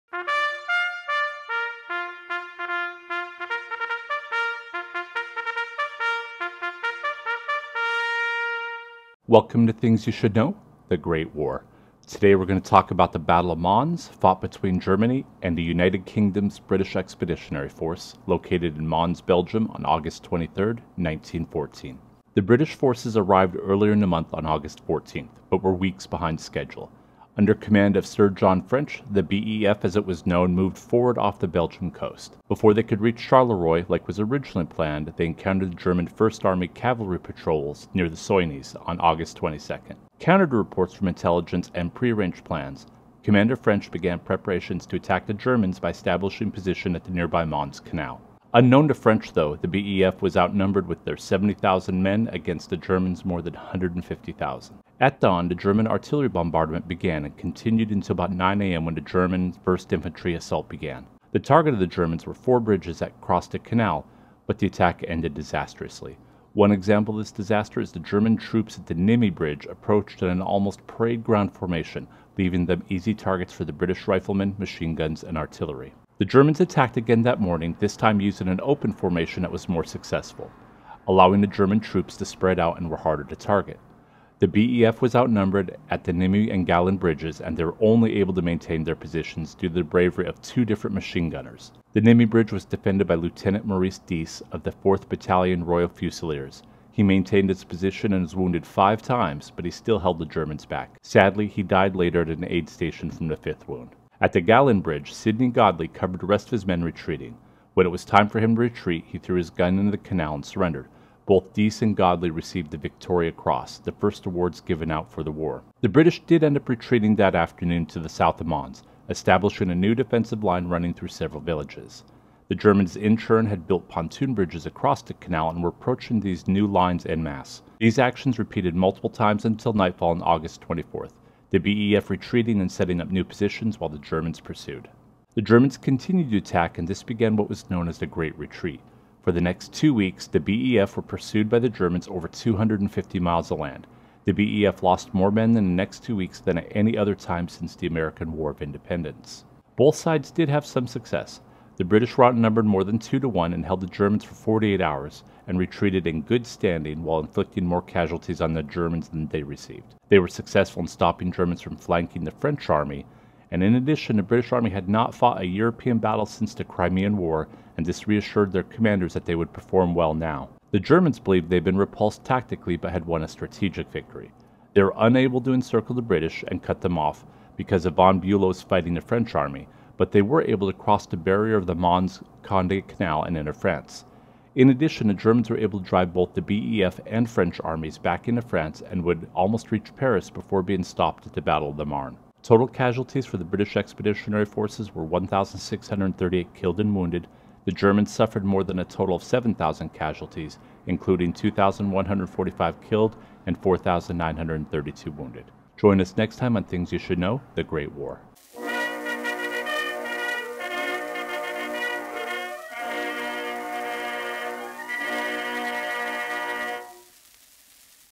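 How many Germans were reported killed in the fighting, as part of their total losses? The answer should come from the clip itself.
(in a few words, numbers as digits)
2,145.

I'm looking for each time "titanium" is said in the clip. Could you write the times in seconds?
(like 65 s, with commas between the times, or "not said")
not said.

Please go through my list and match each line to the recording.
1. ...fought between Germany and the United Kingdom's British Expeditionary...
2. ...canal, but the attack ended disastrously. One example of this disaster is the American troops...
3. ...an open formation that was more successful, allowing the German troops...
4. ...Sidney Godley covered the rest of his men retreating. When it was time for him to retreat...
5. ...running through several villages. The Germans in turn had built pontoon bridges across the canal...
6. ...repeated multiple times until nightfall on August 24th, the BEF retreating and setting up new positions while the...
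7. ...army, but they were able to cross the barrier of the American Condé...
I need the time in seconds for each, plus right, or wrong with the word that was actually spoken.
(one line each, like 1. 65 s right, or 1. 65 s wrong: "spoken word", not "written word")
1. 14 s right
2. 63 s wrong: "German", not "American"
3. 78 s right
4. 105 s right
5. 120 s right
6. 128 s right
7. 179 s wrong: "Mons", not "American".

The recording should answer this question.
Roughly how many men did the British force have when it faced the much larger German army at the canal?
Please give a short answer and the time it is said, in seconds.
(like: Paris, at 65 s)
70,000, at 51 s.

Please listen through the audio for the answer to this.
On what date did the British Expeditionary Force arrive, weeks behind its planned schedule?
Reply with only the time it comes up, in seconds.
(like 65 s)
24 s.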